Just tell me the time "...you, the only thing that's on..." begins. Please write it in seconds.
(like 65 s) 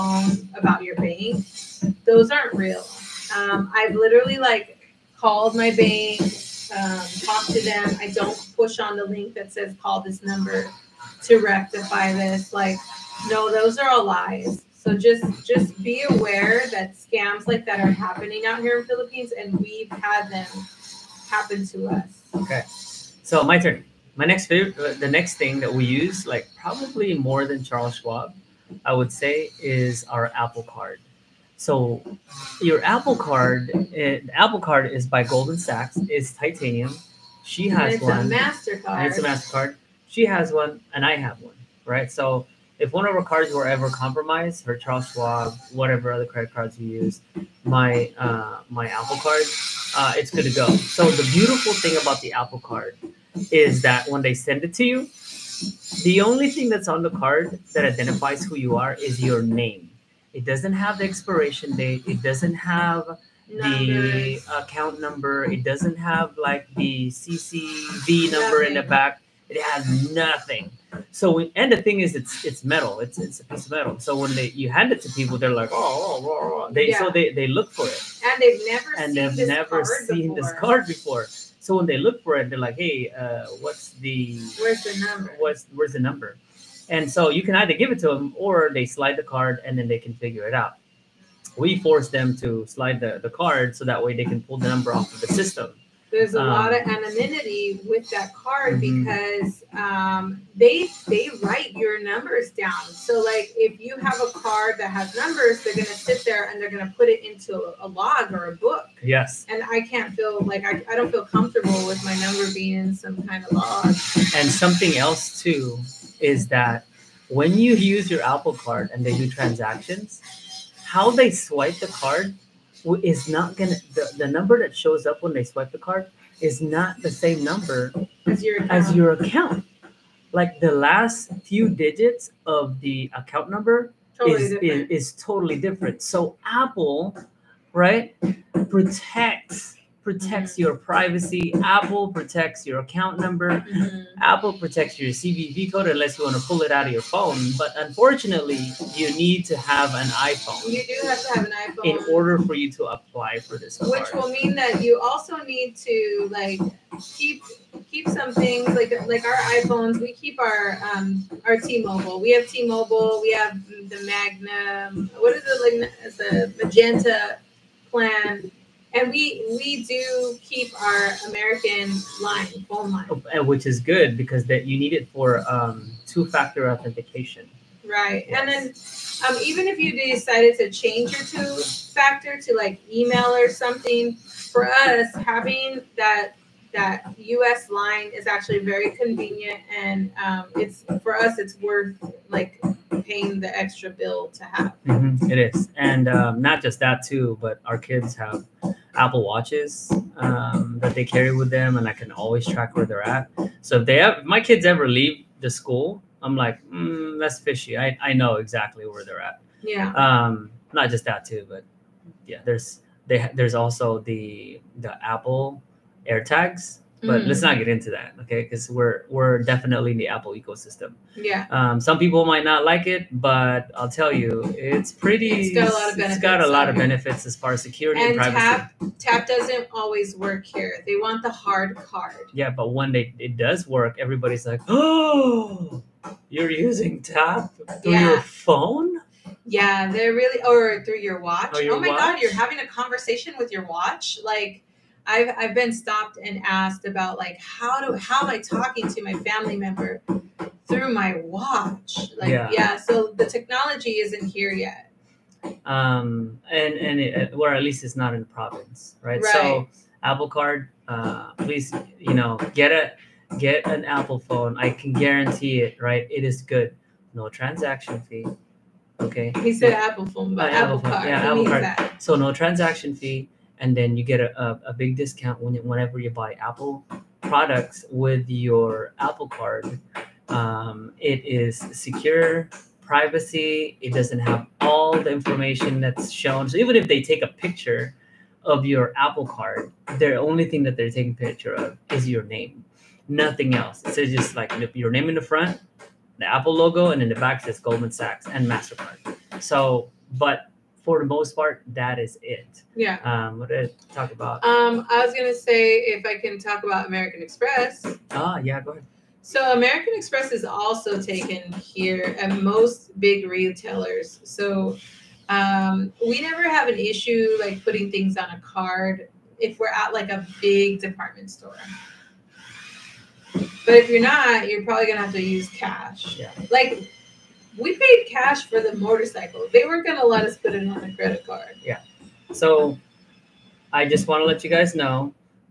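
54 s.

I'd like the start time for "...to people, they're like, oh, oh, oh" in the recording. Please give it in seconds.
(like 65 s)
75 s.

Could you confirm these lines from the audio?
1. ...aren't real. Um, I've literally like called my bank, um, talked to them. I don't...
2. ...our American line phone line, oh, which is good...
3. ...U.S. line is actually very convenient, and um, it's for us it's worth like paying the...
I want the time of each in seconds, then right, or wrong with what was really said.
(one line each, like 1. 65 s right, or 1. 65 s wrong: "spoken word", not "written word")
1. 2 s right
2. 170 s right
3. 187 s right.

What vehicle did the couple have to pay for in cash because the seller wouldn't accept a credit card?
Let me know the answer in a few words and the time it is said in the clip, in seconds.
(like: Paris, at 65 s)
motorcycle, at 328 s.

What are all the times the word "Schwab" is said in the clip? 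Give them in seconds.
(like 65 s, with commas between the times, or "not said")
27 s, 45 s.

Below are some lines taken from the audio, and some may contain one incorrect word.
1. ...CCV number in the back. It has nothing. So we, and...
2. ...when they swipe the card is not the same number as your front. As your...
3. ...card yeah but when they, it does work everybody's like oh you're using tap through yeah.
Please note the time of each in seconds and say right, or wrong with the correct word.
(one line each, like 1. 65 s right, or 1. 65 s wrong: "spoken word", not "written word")
1. 67 s right
2. 125 s wrong: "account", not "front"
3. 231 s right.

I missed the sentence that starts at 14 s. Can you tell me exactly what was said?
So just just be aware that scams like that are happening out here in Philippines, and we've had them happen to us.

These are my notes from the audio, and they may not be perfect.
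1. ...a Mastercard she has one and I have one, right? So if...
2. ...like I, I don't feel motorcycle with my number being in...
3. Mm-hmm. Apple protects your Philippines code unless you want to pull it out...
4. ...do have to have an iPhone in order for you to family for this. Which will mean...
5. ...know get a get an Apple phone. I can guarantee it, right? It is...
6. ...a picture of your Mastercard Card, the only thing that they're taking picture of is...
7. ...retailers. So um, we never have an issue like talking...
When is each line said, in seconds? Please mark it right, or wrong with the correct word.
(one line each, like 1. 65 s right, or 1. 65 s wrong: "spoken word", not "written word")
1. 39 s right
2. 110 s wrong: "comfortable", not "motorcycle"
3. 143 s wrong: "CVV", not "Philippines"
4. 150 s wrong: "apply", not "family"
5. 262 s right
6. 287 s wrong: "Apple", not "Mastercard"
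7. 313 s wrong: "putting", not "talking".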